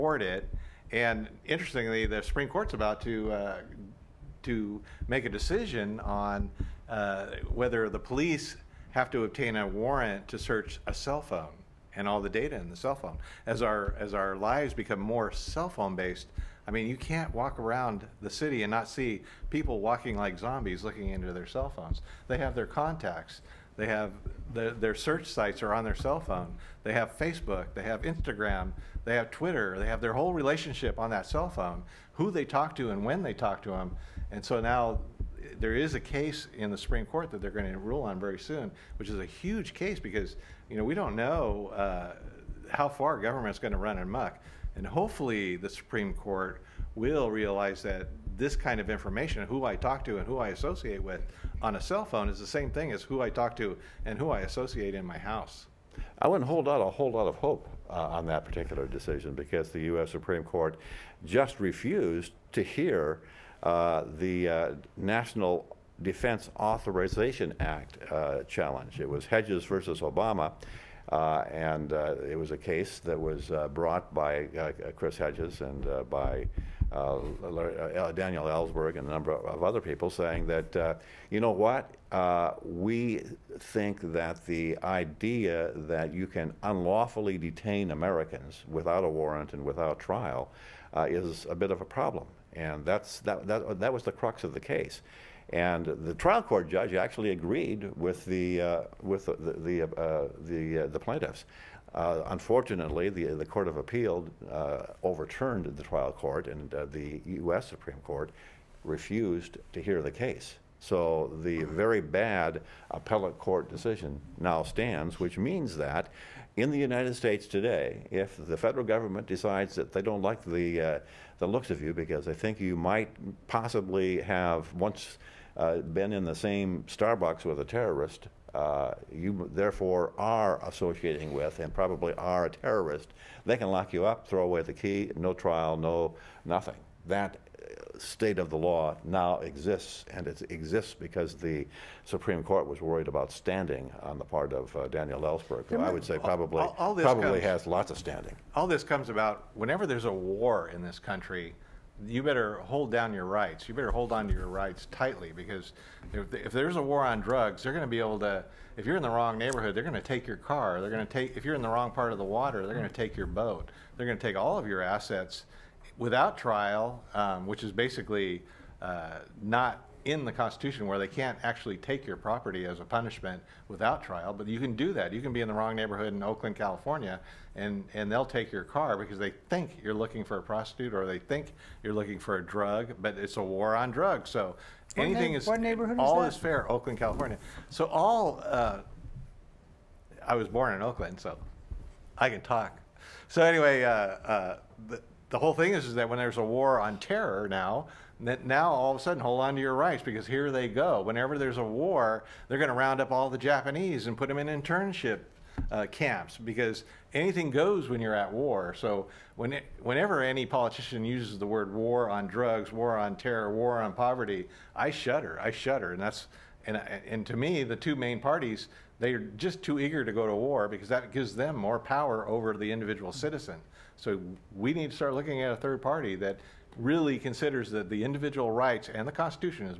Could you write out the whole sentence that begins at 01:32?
And that's, that, that, that was the crux of the case.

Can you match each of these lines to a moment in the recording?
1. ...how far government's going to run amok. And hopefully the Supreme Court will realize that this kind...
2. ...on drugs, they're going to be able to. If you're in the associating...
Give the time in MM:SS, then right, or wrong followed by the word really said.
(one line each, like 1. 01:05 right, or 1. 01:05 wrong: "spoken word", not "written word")
1. 00:42 right
2. 02:37 wrong: "wrong", not "associating".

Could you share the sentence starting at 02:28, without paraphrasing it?
All this comes about whenever there's a war in this country you better hold down your rights.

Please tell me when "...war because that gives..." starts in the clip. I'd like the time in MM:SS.
03:40.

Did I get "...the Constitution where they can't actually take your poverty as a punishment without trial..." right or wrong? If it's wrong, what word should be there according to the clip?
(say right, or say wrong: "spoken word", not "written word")
wrong: "property", not "poverty".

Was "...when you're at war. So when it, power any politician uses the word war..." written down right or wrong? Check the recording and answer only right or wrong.
wrong.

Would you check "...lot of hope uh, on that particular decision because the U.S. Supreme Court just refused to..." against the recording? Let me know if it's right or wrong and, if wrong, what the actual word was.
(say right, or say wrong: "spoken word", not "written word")
right.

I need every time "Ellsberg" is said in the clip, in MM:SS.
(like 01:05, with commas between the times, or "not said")
01:18, 02:25.